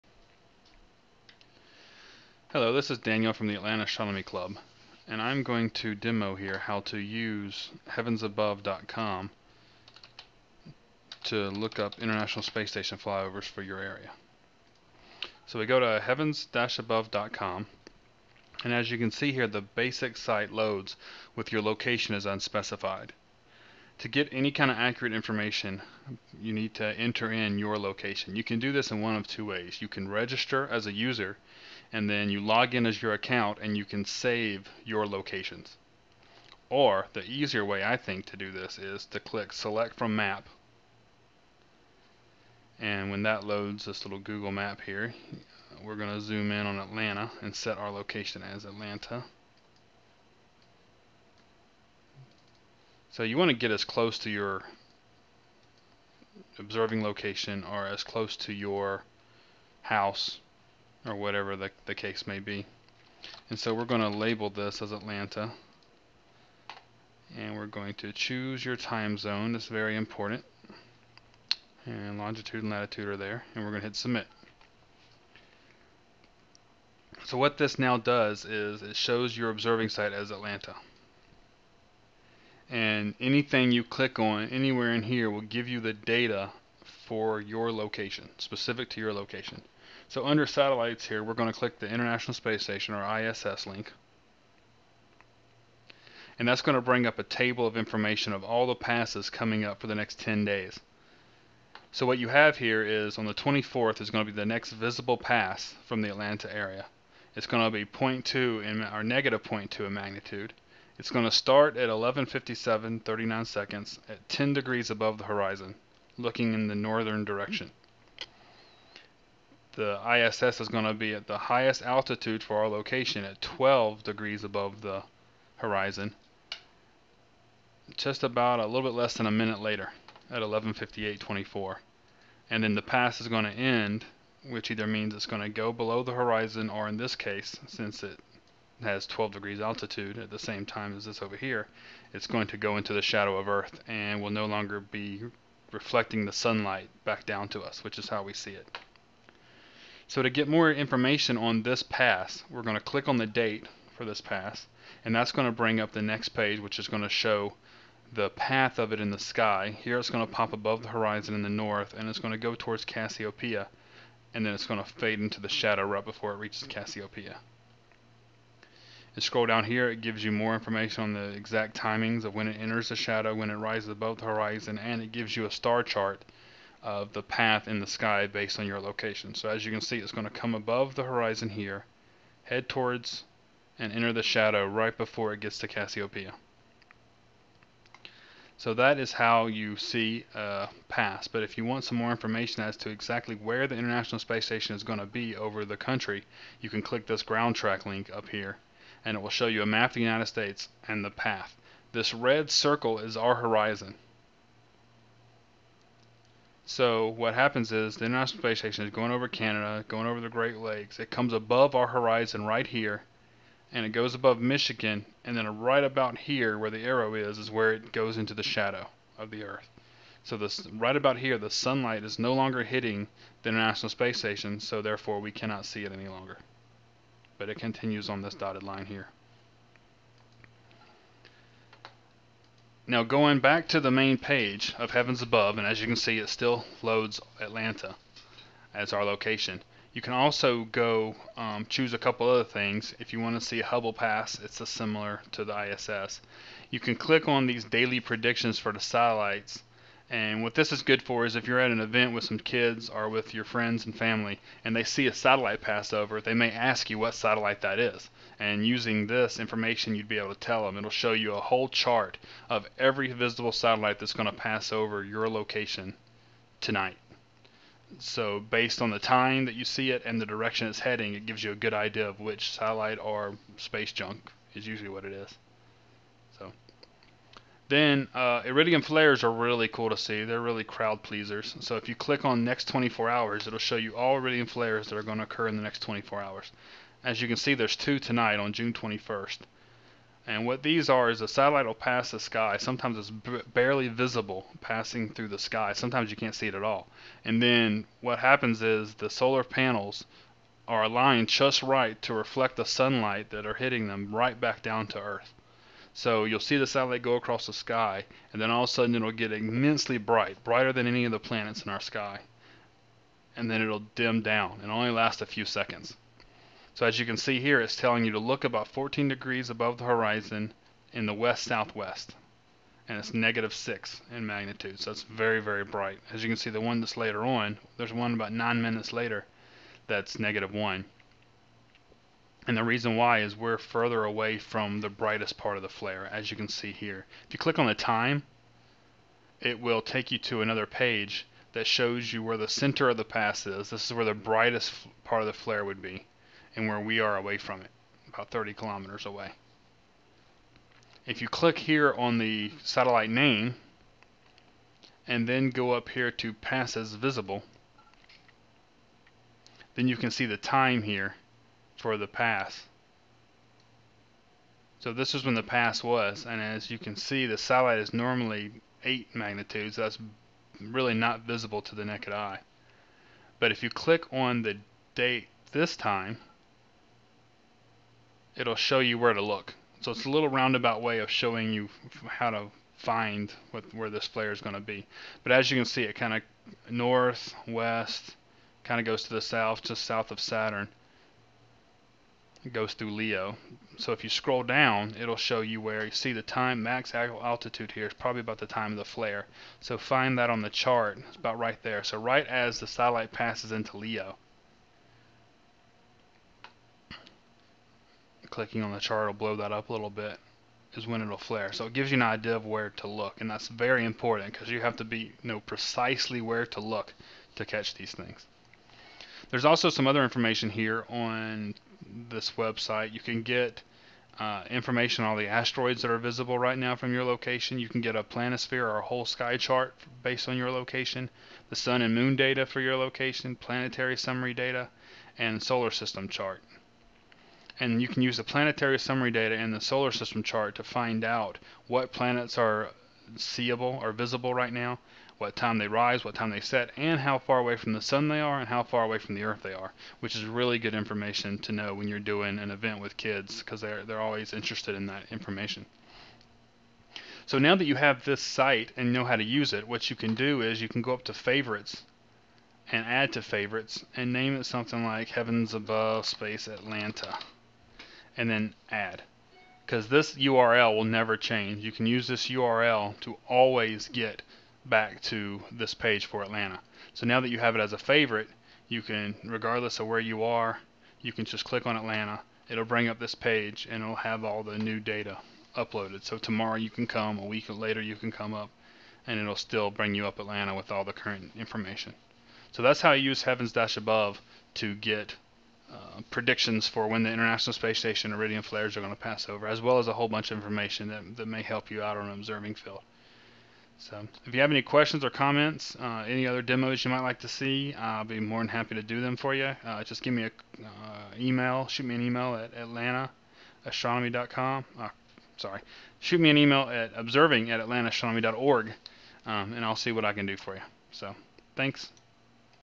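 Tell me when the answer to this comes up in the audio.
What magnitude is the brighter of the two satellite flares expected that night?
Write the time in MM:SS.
05:23.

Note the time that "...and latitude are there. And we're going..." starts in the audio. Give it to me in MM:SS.
01:12.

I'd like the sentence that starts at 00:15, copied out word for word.
So we go to heavens-above.com, and as you can see here, the basic site loads with your location is unspecified.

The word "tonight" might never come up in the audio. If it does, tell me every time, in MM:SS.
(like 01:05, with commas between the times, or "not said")
04:26, 04:47.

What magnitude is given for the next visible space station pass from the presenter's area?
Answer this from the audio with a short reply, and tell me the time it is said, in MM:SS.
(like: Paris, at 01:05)
-0.2, at 01:49.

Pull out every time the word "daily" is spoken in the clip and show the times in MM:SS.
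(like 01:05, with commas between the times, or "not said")
04:07.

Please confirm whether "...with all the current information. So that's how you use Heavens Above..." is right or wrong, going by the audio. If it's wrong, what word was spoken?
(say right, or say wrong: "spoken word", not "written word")
wrong: "Dash", not "Above".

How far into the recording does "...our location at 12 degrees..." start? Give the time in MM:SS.
02:02.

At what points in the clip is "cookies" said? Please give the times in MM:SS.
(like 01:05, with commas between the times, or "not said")
not said.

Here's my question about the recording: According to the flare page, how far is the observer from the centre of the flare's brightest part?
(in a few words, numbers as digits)
About 30 kilometers.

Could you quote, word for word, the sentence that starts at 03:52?
Now going back to the main page of Heavens Above, and as you can see it still loads Atlanta as our location.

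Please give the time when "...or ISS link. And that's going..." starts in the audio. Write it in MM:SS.
01:32.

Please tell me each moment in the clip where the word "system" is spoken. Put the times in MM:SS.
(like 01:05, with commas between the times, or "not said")
07:15, 07:19.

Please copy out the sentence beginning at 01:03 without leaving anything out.
And so we're going to label this as Atlanta.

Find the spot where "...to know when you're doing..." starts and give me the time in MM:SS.
07:31.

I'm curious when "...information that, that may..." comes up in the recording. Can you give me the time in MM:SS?
08:20.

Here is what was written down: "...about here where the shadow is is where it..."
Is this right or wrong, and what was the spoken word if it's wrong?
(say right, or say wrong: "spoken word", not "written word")
wrong: "arrow", not "shadow".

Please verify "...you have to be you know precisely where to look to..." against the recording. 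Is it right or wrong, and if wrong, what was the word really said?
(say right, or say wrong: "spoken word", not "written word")
right.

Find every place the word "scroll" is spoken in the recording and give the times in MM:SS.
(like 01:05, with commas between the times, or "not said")
02:49, 06:34.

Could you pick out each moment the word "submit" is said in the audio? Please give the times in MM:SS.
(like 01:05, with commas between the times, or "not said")
01:13.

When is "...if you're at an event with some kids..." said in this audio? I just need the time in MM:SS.
04:11.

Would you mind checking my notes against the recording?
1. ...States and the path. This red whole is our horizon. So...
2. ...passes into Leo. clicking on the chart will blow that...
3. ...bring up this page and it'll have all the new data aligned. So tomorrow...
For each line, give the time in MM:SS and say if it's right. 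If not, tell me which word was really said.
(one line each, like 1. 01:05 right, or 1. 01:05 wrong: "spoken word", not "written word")
1. 03:20 wrong: "circle", not "whole"
2. 06:43 right
3. 08:02 wrong: "uploaded", not "aligned".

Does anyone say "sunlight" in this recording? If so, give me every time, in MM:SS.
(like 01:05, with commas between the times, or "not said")
02:26, 03:41, 05:02.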